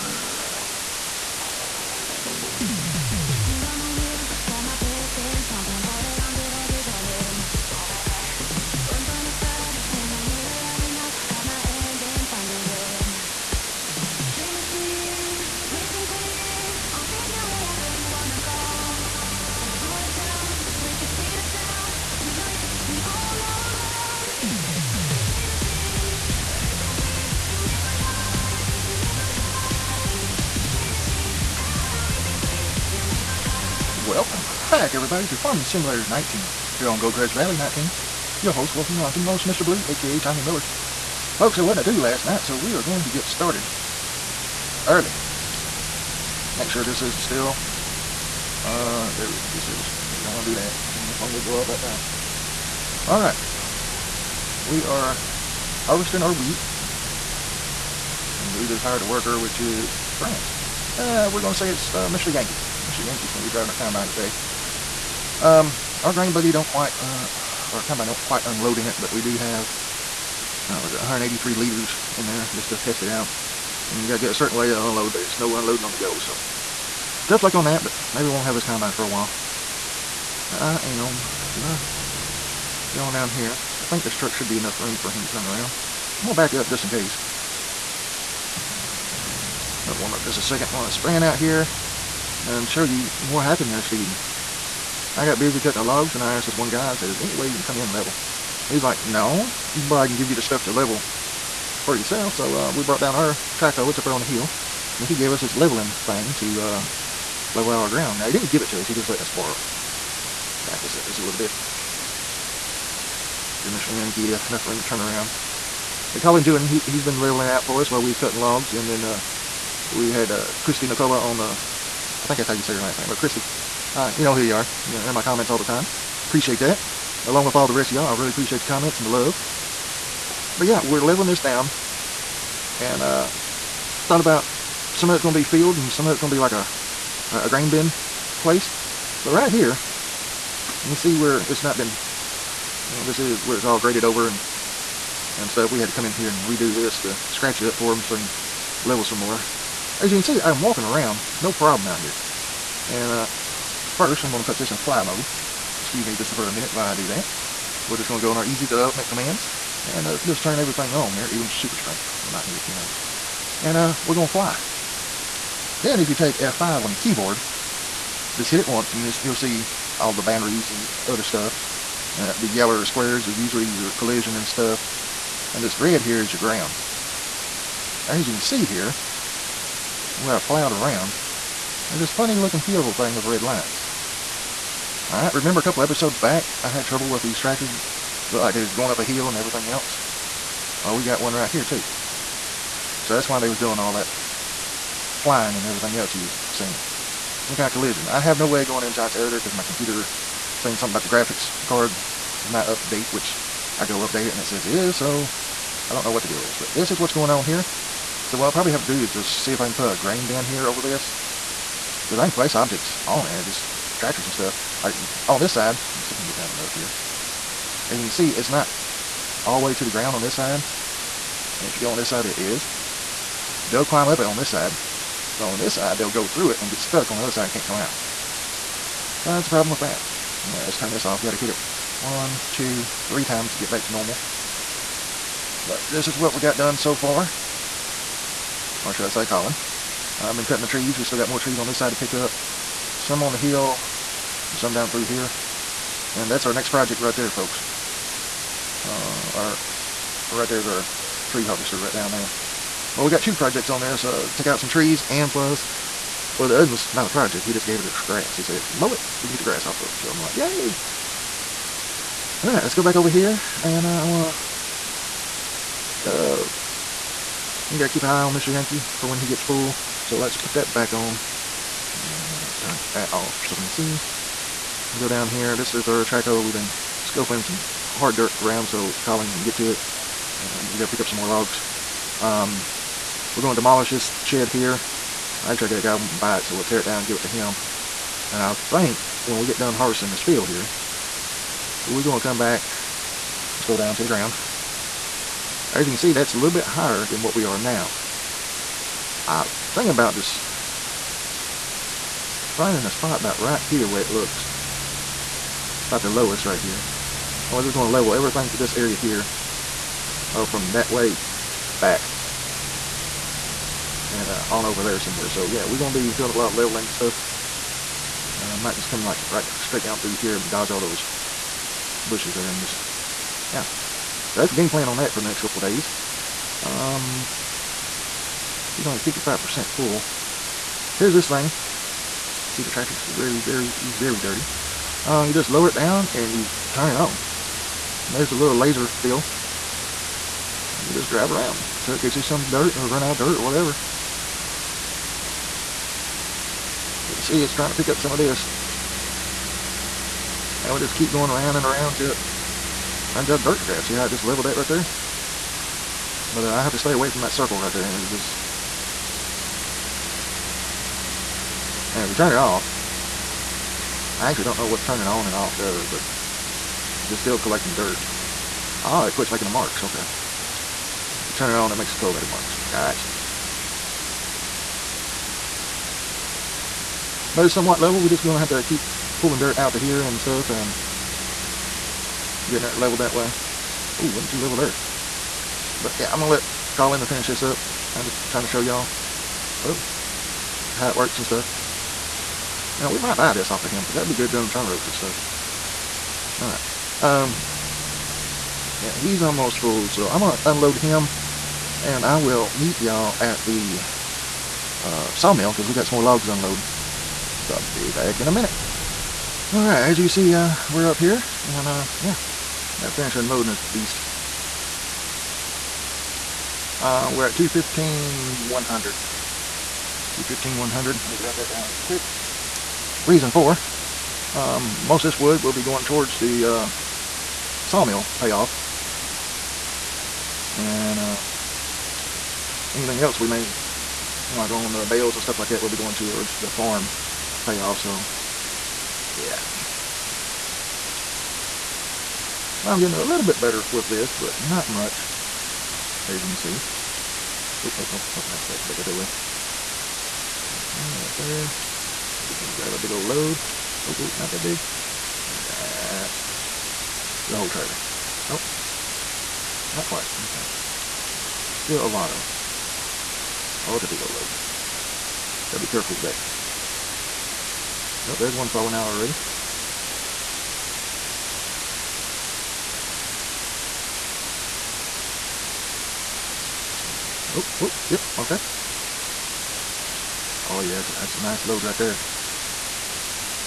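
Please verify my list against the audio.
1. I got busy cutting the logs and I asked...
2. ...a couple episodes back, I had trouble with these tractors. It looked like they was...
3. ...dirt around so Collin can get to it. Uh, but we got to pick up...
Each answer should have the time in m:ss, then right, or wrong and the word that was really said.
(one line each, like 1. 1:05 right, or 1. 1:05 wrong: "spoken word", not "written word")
1. 1:35 right
2. 3:05 right
3. 4:38 right.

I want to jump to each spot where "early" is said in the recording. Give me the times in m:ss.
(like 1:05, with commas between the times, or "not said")
0:44.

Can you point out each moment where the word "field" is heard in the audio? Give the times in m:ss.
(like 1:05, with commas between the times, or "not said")
2:15, 4:50.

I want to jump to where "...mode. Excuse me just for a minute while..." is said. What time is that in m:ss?
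2:35.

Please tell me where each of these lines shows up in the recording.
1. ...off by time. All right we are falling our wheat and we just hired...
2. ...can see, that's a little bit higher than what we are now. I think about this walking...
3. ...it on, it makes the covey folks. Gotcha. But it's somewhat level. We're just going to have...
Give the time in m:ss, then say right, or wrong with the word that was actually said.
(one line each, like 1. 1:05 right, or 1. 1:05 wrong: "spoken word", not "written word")
1. 0:51 wrong: "harvesting", not "falling"
2. 4:55 wrong: "finding", not "walking"
3. 6:11 wrong: "marks", not "folks".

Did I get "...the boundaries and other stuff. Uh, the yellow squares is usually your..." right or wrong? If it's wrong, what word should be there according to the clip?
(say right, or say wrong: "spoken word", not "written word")
right.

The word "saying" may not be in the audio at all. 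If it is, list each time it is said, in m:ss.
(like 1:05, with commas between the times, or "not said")
3:20.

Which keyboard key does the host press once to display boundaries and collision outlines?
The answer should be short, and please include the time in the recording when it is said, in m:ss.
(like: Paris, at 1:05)
F5, at 2:46.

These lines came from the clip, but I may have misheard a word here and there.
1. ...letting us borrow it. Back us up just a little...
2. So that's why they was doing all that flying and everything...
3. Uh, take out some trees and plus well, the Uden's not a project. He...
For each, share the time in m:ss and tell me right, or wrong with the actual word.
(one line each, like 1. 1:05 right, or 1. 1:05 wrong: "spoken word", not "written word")
1. 1:49 right
2. 3:13 right
3. 4:14 right.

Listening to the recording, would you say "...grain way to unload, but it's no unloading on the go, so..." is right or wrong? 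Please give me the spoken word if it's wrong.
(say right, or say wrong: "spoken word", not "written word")
wrong: "certain", not "grain".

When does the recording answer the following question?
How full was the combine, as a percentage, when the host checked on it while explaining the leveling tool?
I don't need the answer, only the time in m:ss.
5:28.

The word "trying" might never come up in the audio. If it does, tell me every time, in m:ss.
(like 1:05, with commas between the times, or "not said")
5:47, 6:28.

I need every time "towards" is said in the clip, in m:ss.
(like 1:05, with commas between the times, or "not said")
7:05, 7:15.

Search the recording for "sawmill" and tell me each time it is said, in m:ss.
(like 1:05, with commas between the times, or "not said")
6:45, 7:07.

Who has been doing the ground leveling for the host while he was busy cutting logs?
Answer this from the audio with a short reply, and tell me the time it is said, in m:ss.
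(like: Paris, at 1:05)
Collin Julian, at 1:56.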